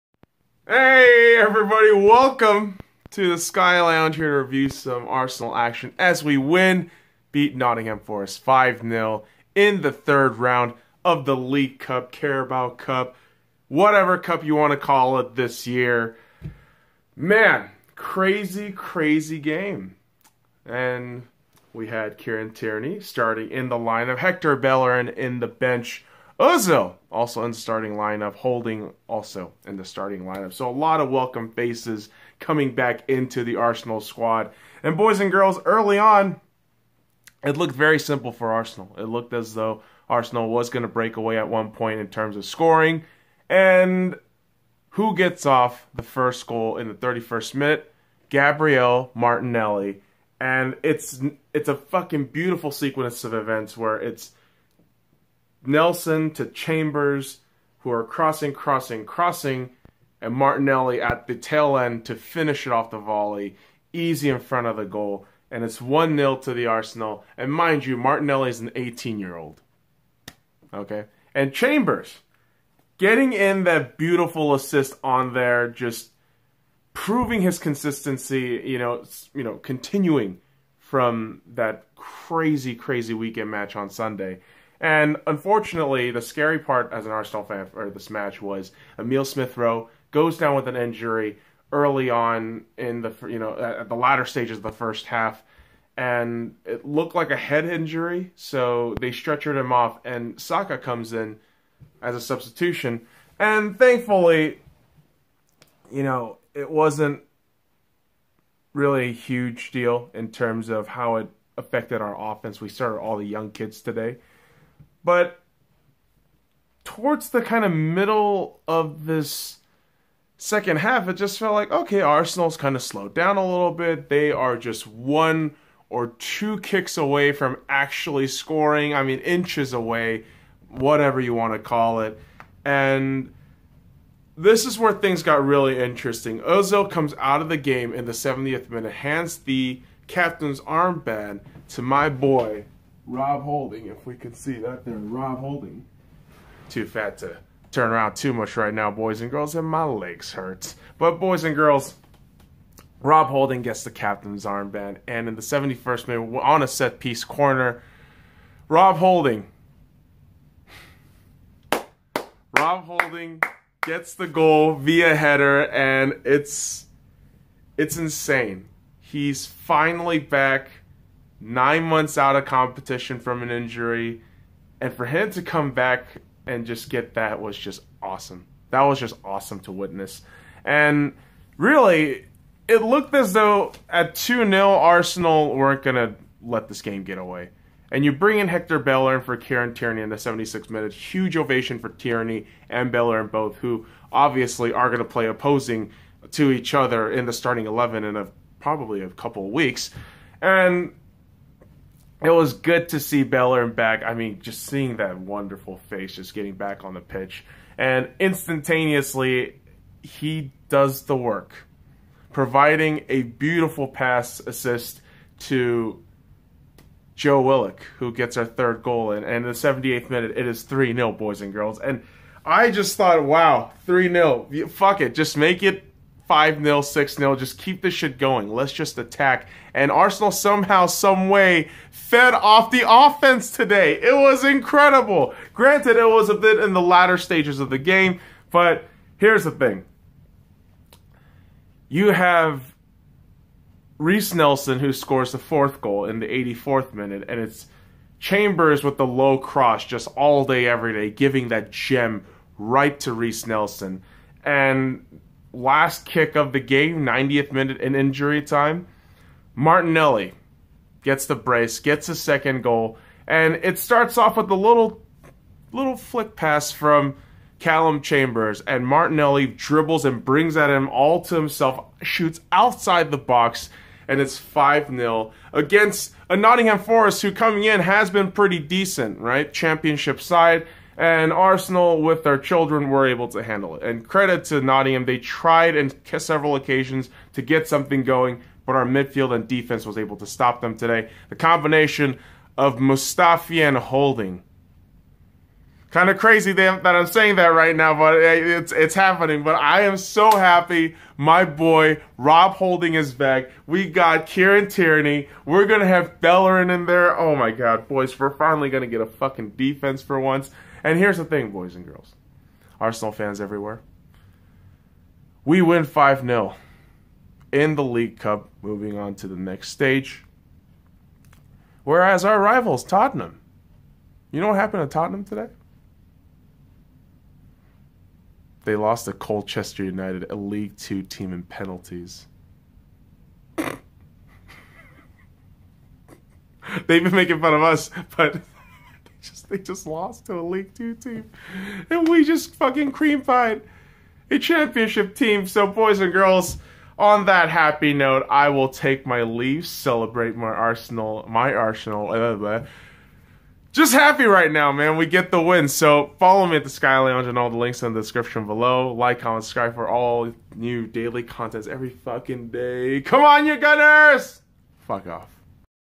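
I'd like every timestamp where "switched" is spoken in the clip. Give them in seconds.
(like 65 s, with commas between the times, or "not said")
not said.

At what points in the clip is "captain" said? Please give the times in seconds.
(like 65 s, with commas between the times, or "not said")
140 s, 153 s.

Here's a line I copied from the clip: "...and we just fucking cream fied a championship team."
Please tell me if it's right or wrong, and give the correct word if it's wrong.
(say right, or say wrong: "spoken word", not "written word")
right.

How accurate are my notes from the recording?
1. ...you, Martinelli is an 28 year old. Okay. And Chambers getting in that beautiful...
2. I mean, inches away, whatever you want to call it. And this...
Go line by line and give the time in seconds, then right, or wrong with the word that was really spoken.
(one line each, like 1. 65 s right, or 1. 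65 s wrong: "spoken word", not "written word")
1. 67 s wrong: "18", not "28"
2. 128 s right.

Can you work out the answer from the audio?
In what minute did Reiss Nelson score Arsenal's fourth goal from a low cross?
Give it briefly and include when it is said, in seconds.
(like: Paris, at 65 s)
84th, at 246 s.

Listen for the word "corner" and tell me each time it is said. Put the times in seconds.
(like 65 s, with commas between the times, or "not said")
157 s.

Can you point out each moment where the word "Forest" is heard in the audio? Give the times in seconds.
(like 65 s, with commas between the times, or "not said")
8 s, 276 s.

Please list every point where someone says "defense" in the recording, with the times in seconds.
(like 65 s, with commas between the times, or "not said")
289 s, 309 s.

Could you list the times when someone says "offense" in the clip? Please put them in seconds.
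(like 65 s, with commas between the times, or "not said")
112 s, 232 s.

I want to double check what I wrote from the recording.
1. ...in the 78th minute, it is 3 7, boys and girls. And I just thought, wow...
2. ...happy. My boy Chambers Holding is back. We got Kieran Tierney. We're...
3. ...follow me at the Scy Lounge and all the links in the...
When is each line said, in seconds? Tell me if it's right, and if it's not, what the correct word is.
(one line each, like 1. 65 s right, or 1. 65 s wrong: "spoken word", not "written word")
1. 219 s wrong: "0", not "7"
2. 300 s wrong: "Rob", not "Chambers"
3. 356 s right.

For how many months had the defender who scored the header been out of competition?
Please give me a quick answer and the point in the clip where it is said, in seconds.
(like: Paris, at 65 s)
9, at 171 s.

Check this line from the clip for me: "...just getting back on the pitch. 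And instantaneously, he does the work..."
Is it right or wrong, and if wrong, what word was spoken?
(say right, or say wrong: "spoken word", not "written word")
right.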